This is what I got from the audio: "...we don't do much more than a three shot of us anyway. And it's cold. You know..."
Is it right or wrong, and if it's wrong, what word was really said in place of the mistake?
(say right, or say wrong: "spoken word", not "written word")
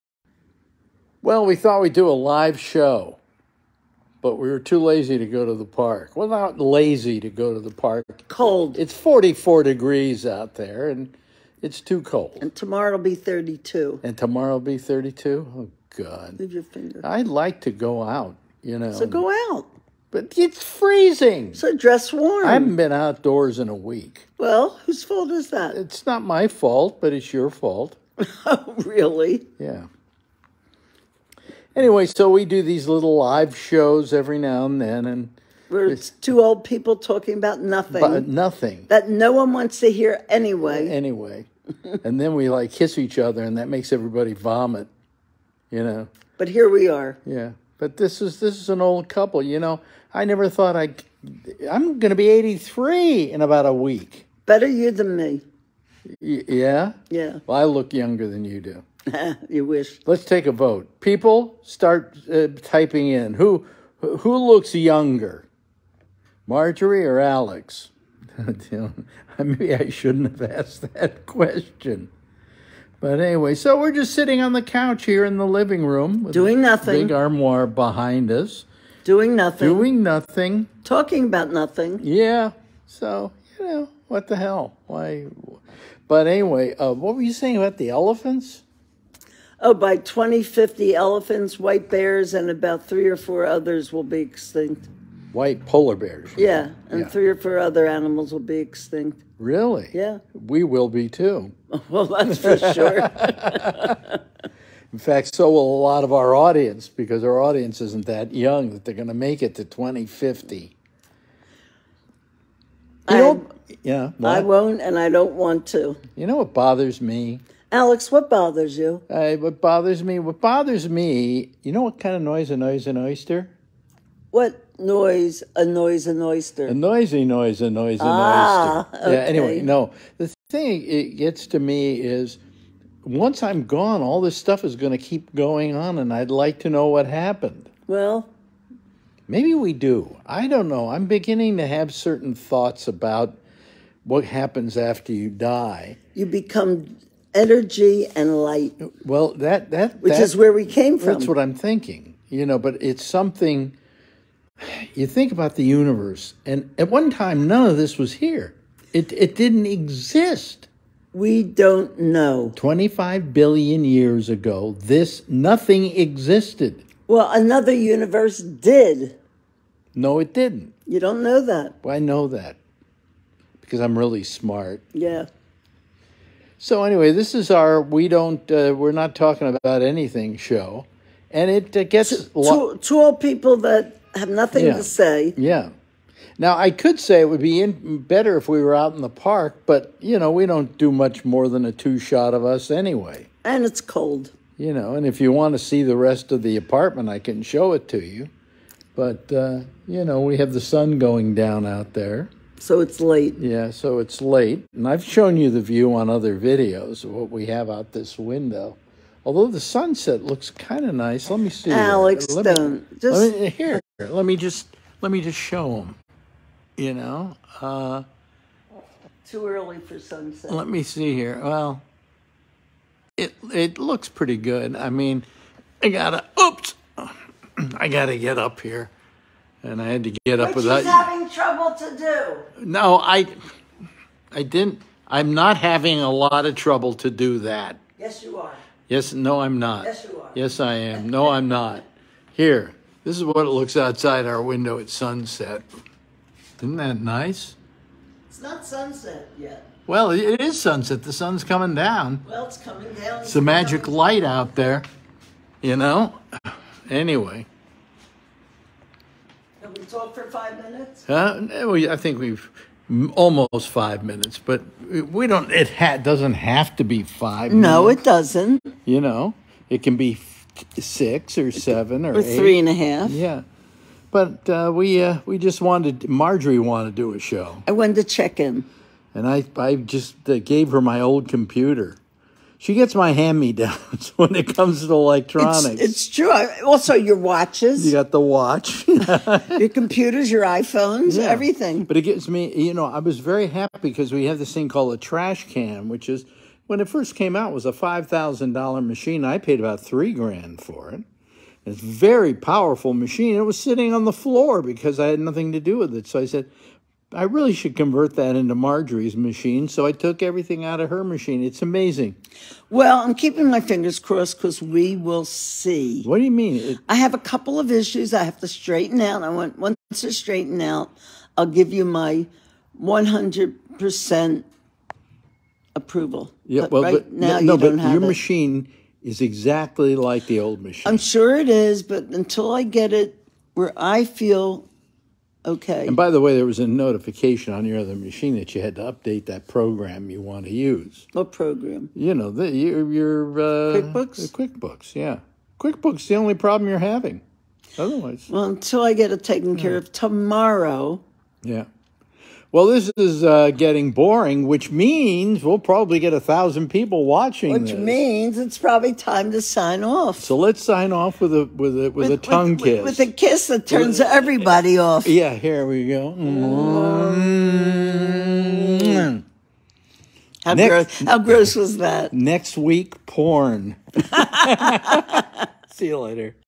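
wrong: "two", not "three".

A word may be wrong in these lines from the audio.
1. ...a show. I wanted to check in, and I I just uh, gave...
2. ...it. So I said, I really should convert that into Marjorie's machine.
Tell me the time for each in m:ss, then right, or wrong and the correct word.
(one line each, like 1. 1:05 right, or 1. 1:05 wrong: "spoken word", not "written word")
1. 4:37 right
2. 5:05 right.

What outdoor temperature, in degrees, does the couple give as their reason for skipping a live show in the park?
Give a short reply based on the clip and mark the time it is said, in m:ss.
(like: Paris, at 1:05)
44 degrees, at 0:08.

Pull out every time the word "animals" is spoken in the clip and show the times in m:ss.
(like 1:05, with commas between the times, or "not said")
1:37.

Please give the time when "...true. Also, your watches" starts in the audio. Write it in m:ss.
4:46.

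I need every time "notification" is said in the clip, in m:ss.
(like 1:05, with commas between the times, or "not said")
5:36.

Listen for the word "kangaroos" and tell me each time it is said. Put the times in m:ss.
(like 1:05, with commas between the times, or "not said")
not said.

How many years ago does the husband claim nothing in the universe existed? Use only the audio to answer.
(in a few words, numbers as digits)
25 billion.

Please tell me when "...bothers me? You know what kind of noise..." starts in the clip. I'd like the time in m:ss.
2:00.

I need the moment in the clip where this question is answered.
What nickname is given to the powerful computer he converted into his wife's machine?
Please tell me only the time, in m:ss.
4:54.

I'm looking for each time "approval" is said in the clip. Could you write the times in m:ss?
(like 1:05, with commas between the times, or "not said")
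5:25.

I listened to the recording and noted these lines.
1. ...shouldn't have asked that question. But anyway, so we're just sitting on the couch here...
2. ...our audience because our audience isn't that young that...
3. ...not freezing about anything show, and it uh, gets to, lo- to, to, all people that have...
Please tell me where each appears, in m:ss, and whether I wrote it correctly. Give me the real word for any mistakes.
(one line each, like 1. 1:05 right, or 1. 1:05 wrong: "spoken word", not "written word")
1. 1:09 right
2. 1:46 right
3. 2:58 wrong: "talking", not "freezing".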